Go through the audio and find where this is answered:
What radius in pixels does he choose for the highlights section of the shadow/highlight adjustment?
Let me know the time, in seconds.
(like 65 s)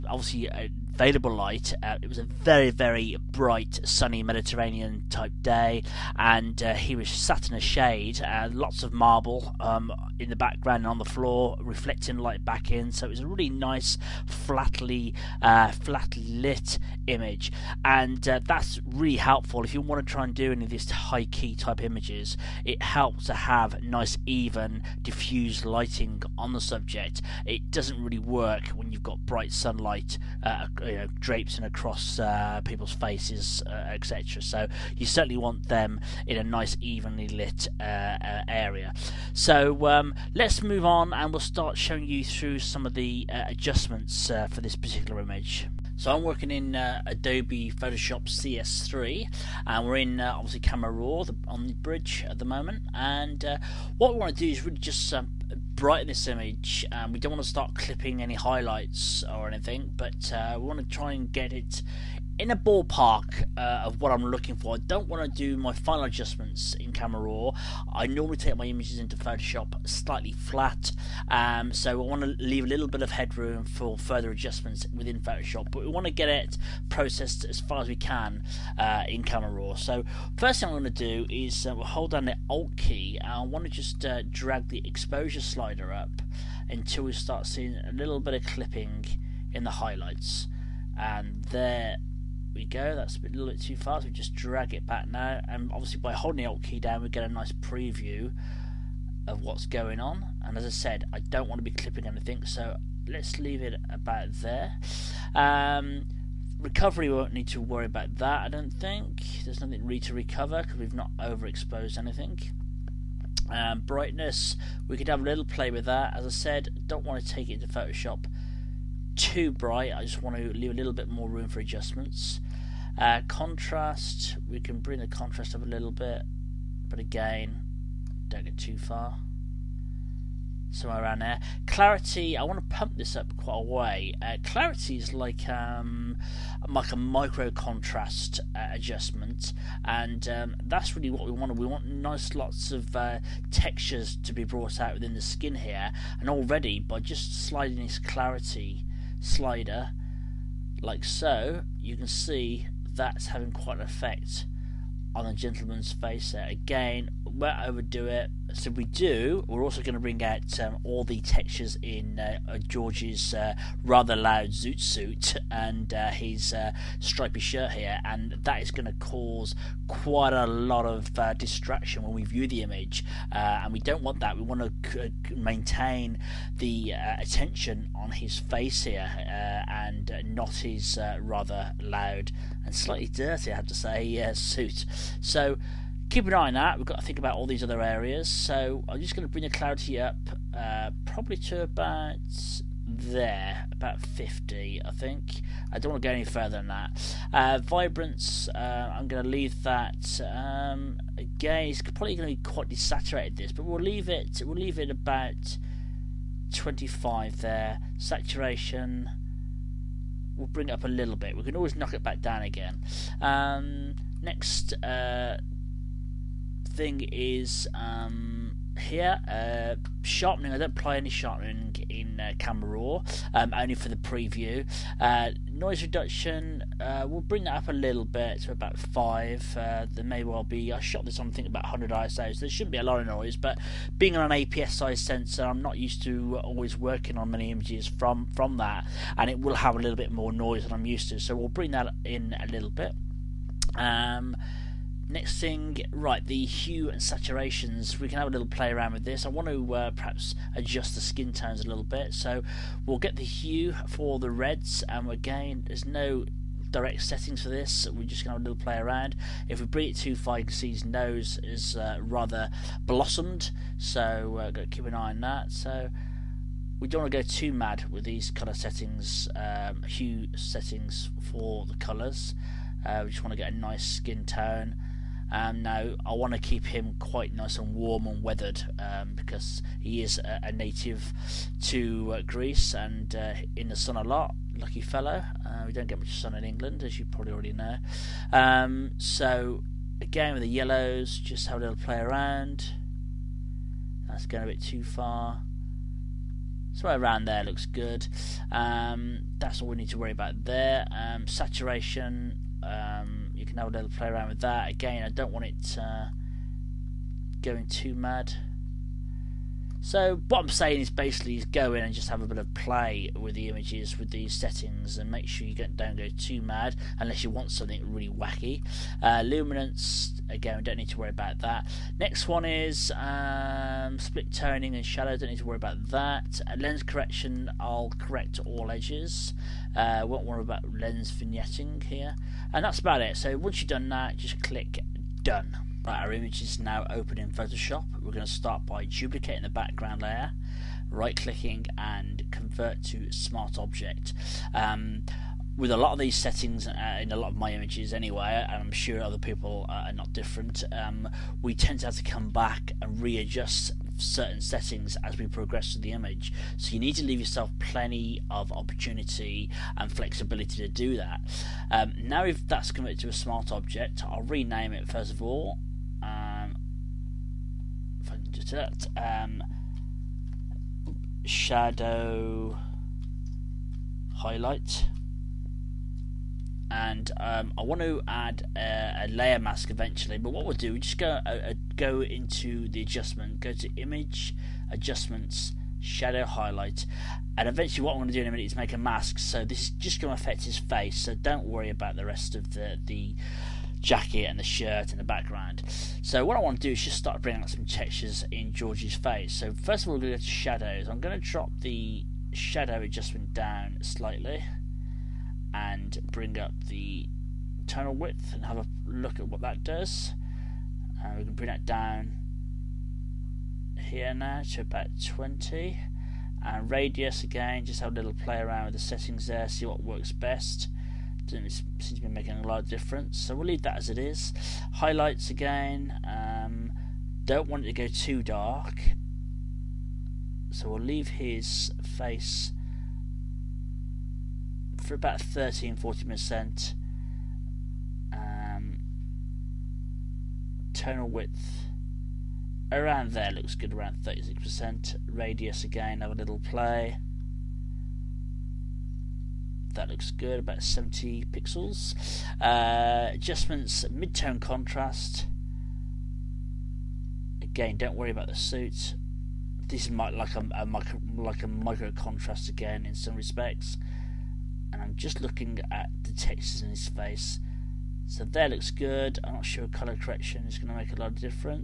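450 s.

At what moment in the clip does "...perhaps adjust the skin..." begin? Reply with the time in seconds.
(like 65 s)
249 s.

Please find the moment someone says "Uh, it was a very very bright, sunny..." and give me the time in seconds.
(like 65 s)
1 s.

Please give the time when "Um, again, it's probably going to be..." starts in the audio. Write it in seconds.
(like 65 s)
200 s.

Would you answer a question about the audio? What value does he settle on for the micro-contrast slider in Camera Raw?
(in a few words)
50.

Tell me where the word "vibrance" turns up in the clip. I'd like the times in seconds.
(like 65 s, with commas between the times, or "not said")
197 s.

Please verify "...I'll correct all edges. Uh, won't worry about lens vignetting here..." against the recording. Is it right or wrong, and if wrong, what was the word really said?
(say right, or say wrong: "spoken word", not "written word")
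right.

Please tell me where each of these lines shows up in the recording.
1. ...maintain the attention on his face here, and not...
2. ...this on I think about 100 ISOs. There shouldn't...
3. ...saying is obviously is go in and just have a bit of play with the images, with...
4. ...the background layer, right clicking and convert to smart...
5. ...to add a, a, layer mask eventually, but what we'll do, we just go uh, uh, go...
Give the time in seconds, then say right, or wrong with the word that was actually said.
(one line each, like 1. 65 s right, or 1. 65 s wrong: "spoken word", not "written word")
1. 175 s right
2. 231 s right
3. 310 s wrong: "basically", not "obviously"
4. 339 s right
5. 377 s right.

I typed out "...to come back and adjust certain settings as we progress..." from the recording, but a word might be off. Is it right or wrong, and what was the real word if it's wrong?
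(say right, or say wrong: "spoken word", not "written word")
wrong: "readjust", not "adjust".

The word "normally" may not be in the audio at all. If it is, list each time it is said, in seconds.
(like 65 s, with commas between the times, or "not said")
68 s.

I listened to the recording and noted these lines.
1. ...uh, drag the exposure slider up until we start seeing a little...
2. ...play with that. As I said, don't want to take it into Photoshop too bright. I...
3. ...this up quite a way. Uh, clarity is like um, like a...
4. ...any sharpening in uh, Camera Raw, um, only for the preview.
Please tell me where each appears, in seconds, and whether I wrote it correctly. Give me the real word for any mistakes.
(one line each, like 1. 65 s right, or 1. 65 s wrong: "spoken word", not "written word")
1. 84 s right
2. 115 s right
3. 132 s right
4. 220 s right.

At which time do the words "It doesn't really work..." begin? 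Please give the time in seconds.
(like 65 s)
27 s.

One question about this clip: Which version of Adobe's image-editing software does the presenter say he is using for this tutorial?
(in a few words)
Photoshop CS3.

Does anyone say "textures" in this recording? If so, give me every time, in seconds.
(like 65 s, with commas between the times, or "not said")
143 s, 161 s, 397 s, 466 s.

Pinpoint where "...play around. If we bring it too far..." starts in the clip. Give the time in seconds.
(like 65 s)
258 s.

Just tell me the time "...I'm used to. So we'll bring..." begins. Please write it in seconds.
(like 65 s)
240 s.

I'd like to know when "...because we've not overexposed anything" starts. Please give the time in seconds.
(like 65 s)
110 s.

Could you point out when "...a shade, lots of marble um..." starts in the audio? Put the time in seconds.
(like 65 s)
7 s.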